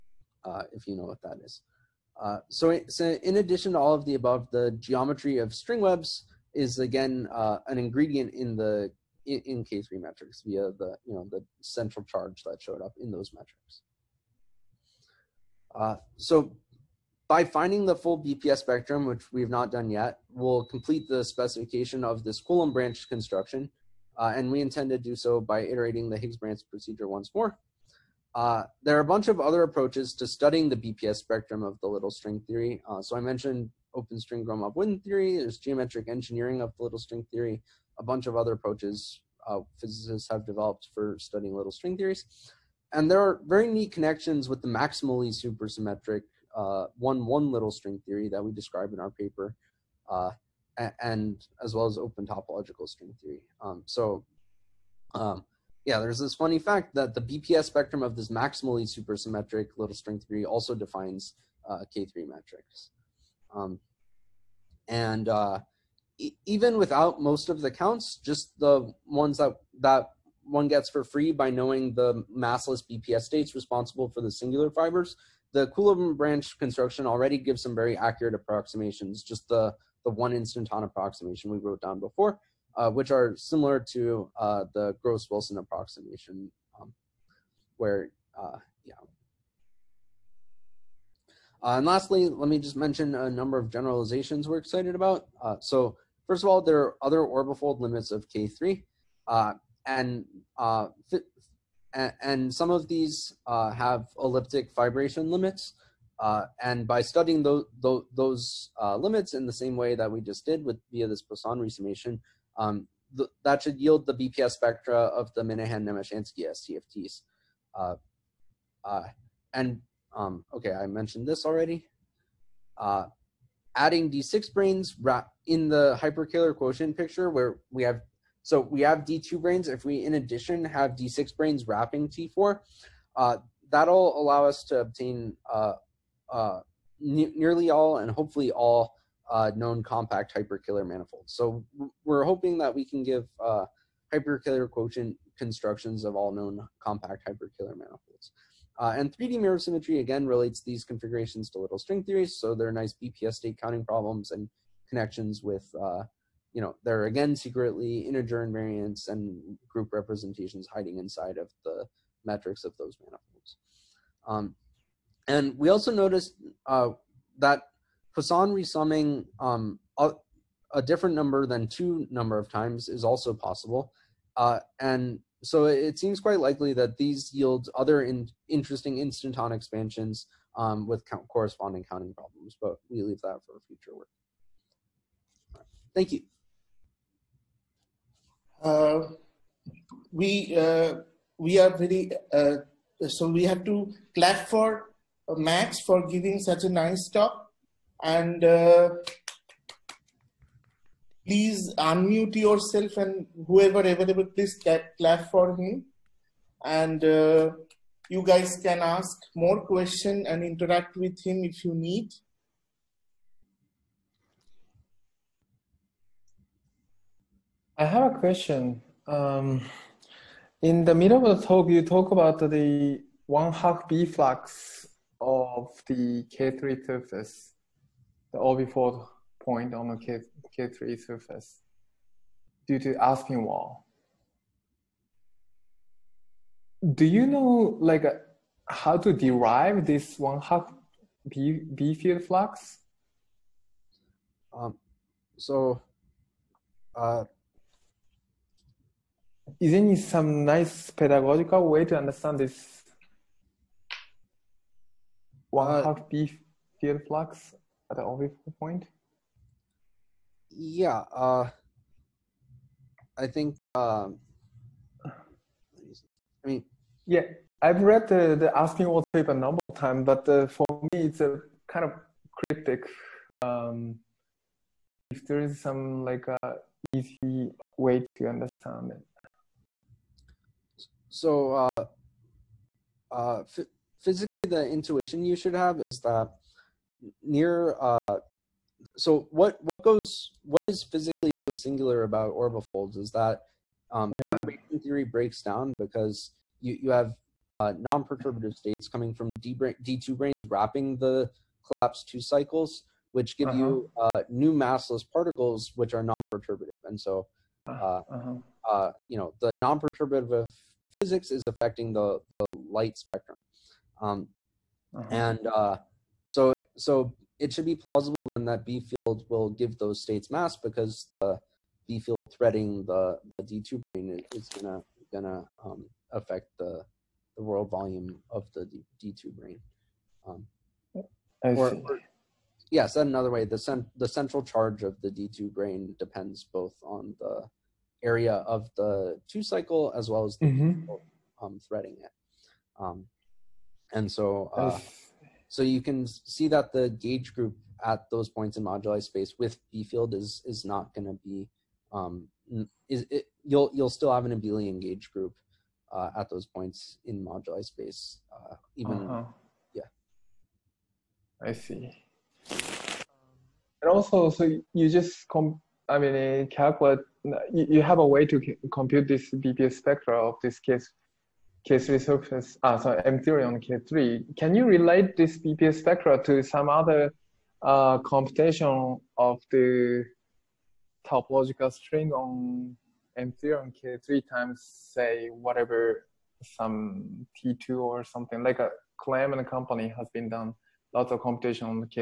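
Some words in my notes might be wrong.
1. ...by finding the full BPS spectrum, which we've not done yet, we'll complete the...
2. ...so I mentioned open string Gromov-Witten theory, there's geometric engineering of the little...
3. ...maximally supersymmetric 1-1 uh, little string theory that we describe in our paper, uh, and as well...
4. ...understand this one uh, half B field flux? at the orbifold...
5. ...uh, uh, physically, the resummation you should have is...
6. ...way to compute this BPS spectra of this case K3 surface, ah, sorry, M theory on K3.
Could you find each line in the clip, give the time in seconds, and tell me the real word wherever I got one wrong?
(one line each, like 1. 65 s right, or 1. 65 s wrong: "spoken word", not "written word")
1. 17 s right
2. 33 s right
3. 44 s right
4. 251 s right
5. 281 s wrong: "intuition", not "resummation"
6. 368 s right.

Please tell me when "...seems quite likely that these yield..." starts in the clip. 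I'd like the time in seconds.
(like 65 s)
175 s.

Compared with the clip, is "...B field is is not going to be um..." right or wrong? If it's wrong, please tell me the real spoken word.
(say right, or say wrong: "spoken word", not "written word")
right.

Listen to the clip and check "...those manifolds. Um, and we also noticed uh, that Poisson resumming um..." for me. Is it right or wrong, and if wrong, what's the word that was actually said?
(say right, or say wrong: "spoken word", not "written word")
right.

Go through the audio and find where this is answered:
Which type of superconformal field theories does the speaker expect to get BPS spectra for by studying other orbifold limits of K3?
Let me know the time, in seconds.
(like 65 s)
115 s.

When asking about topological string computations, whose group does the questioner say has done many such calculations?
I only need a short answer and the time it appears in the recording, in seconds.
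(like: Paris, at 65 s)
Klemm, at 388 s.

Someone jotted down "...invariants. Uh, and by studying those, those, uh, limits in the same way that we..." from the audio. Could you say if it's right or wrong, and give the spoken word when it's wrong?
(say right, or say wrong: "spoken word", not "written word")
wrong: "limits", not "invariants".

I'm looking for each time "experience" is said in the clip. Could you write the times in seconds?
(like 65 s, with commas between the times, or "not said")
not said.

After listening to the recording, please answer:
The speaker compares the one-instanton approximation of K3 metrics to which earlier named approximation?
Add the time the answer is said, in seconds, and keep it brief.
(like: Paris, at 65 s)
Gross-Wilson approximation, at 85 s.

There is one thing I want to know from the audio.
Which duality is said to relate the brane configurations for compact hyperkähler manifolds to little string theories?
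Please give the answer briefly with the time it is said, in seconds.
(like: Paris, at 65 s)
3D mirror symmetry, at 149 s.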